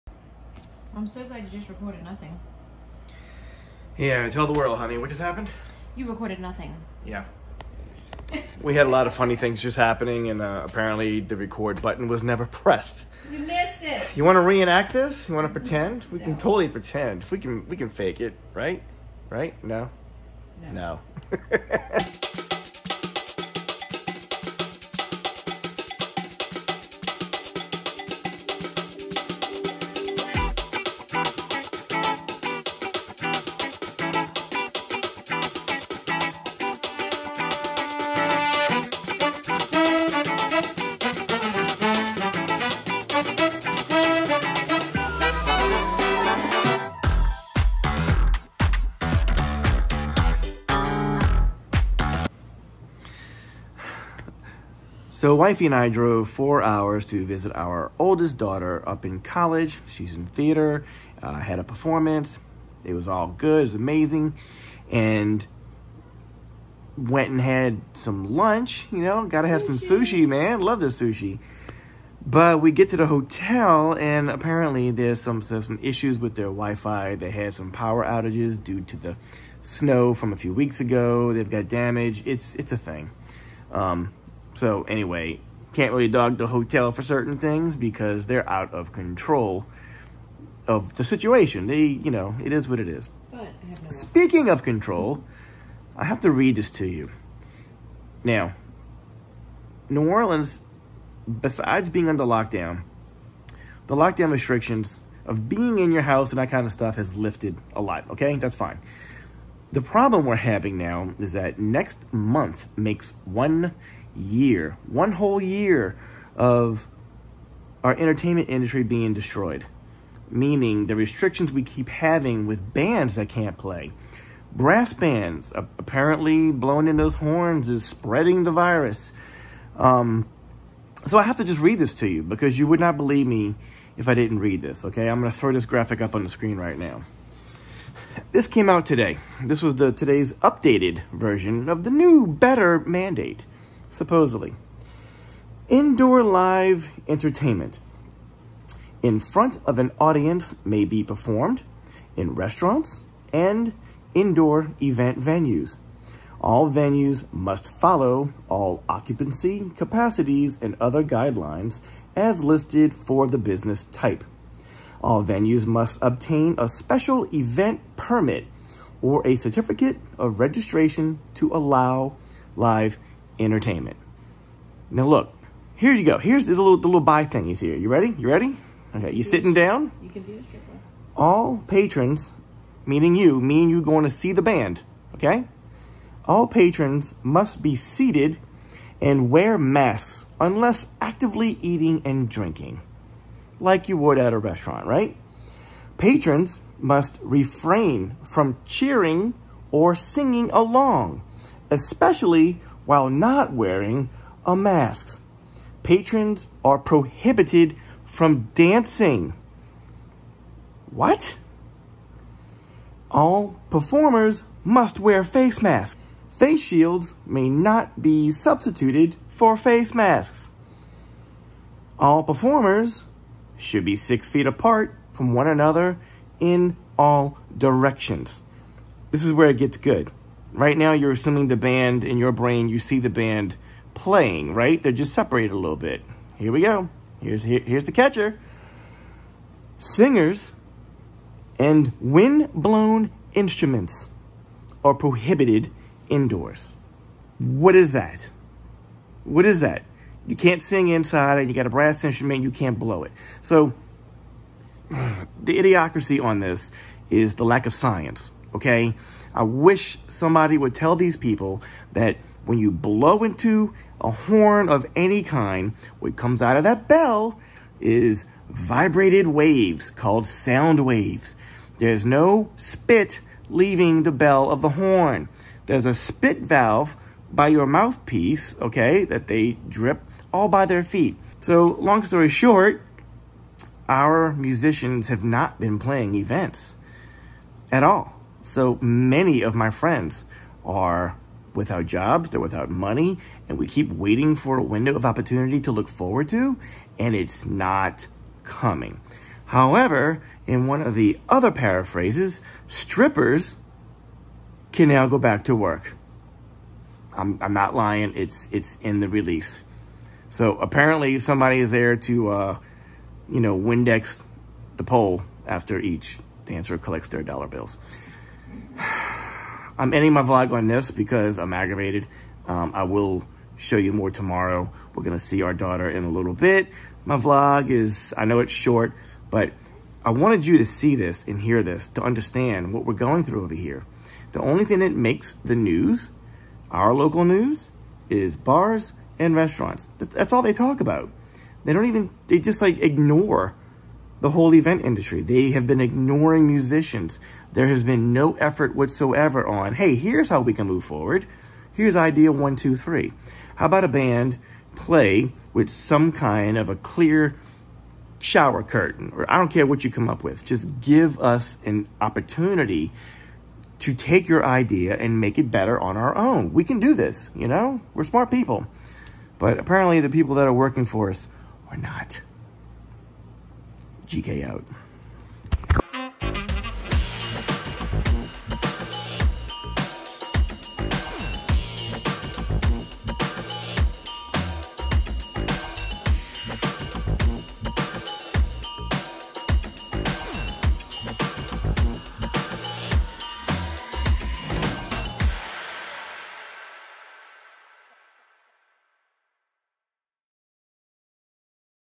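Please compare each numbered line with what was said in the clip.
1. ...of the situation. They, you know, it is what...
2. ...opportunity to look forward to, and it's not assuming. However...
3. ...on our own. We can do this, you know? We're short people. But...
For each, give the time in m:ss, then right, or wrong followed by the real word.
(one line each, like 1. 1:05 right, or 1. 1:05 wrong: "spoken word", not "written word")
1. 1:30 right
2. 4:55 wrong: "coming", not "assuming"
3. 6:05 wrong: "smart", not "short".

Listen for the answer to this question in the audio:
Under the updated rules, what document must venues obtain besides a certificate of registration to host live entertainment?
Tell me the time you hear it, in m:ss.
2:46.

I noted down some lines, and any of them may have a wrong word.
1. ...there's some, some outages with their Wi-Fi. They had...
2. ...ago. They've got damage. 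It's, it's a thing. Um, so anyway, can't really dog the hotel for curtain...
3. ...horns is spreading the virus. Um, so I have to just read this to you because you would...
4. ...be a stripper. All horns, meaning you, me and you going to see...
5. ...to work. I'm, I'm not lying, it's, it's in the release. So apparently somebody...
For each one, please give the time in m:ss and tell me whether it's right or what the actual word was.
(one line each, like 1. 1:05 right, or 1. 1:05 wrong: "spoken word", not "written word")
1. 1:14 wrong: "issues", not "outages"
2. 1:20 wrong: "certain", not "curtain"
3. 2:07 right
4. 3:00 wrong: "patrons", not "horns"
5. 5:05 right.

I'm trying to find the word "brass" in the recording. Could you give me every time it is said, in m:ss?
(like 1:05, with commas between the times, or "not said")
2:04, 4:11.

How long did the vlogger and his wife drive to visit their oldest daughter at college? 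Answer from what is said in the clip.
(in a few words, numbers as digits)
4 hours.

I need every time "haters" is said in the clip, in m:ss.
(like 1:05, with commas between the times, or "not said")
not said.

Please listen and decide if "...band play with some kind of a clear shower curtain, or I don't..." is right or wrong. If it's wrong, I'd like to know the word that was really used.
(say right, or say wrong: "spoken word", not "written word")
right.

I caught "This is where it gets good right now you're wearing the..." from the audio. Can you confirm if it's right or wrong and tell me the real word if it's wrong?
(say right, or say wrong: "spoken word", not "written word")
wrong: "assuming", not "wearing".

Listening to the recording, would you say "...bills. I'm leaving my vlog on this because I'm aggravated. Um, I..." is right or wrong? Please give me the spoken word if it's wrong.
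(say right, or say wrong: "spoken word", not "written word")
wrong: "ending", not "leaving".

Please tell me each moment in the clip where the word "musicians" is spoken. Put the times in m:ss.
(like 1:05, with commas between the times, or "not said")
4:44, 5:46.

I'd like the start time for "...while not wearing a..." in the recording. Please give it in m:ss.
3:22.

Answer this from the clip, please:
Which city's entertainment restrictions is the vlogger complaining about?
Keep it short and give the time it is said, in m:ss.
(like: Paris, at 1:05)
New Orleans, at 1:39.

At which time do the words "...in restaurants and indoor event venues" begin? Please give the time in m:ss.
2:32.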